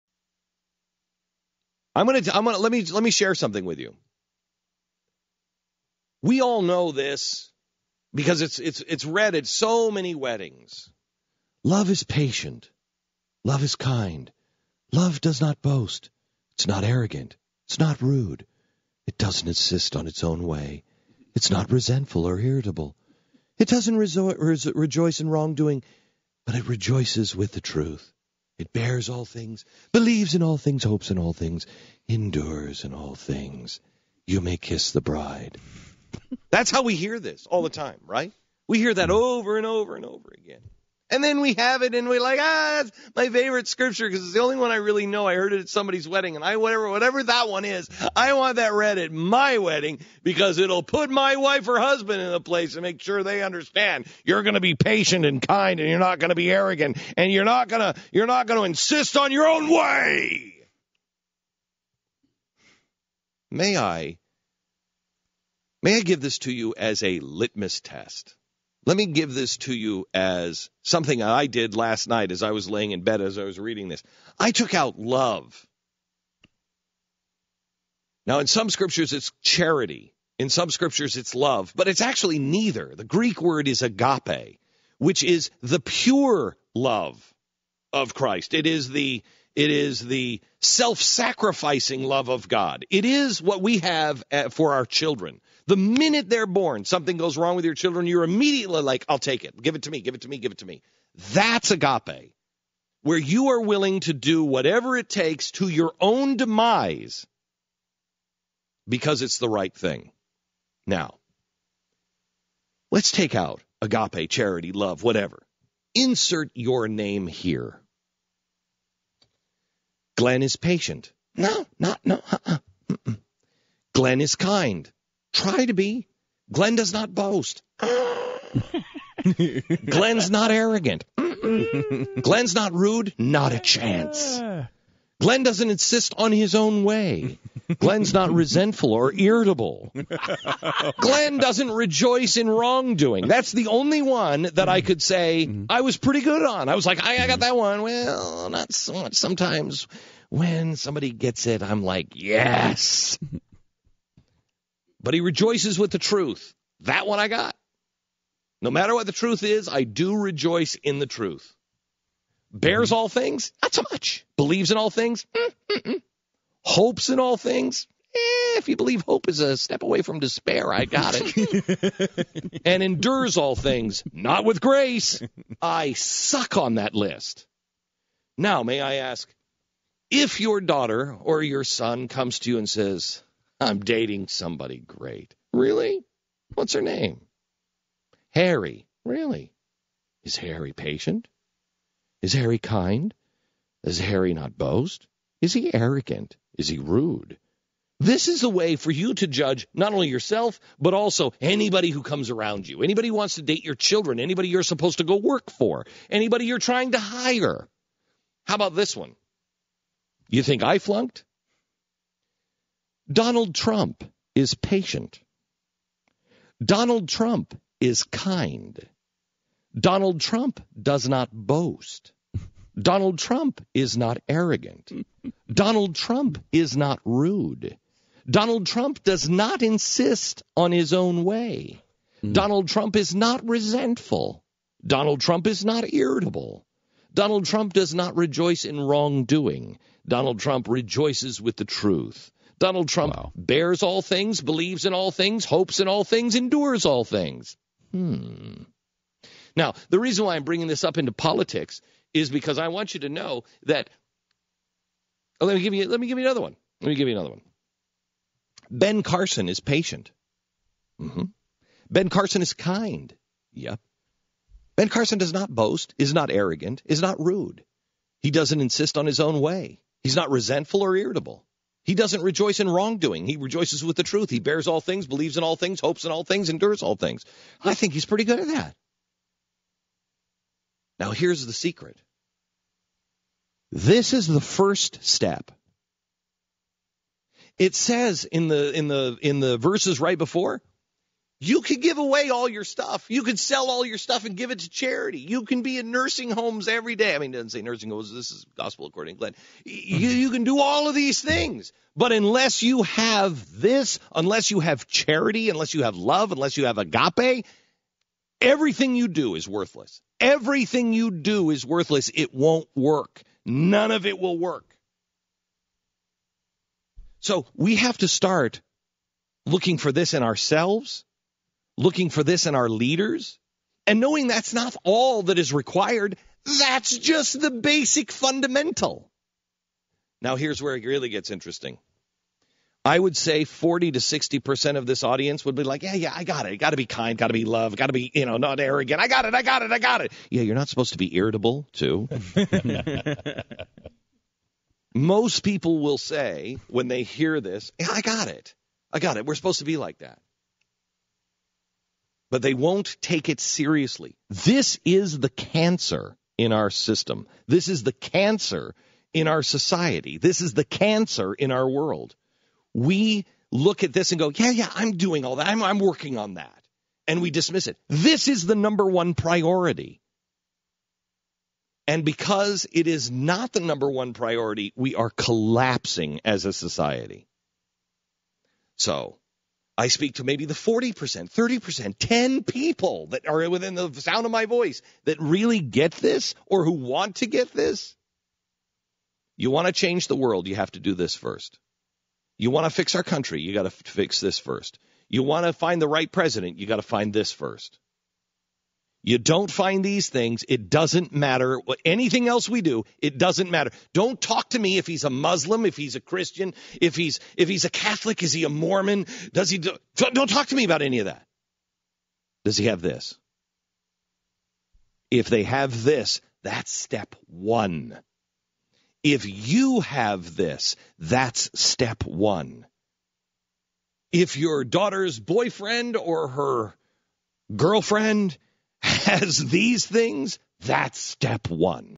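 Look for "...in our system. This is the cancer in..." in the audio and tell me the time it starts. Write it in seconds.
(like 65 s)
356 s.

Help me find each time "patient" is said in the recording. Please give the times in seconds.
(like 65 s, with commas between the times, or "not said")
12 s, 54 s, 120 s, 190 s, 214 s, 259 s.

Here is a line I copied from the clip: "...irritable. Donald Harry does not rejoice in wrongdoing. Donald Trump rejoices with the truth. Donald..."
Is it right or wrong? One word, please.
wrong.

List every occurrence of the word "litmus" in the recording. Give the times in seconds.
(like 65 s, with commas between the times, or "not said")
67 s.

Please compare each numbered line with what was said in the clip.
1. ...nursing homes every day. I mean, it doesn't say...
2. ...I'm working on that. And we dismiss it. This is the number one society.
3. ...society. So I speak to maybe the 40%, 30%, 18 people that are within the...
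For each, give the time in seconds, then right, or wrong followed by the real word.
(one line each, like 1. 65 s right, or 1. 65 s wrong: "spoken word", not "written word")
1. 295 s right
2. 365 s wrong: "priority", not "society"
3. 376 s wrong: "10", not "18".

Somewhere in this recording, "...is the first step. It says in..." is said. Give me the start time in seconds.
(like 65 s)
284 s.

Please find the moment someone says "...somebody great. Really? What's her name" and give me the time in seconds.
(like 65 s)
184 s.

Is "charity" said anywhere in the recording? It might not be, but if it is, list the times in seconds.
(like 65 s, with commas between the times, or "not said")
79 s, 114 s, 294 s, 304 s.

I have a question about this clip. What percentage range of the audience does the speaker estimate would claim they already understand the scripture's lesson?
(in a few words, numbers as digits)
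40 to 60%.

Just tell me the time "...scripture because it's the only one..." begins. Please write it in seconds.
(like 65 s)
43 s.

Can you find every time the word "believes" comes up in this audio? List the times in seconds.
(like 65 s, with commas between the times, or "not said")
29 s, 164 s, 168 s, 244 s, 275 s.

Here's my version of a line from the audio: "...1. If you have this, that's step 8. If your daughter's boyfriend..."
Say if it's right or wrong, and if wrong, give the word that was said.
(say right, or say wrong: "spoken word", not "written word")
wrong: "1", not "8".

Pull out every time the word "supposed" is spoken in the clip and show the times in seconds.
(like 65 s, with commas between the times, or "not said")
204 s, 340 s, 349 s.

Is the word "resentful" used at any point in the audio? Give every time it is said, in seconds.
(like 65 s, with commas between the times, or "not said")
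21 s, 138 s, 233 s, 270 s.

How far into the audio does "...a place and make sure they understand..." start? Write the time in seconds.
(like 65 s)
52 s.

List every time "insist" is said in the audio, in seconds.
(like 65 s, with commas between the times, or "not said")
19 s, 58 s, 135 s, 229 s, 268 s.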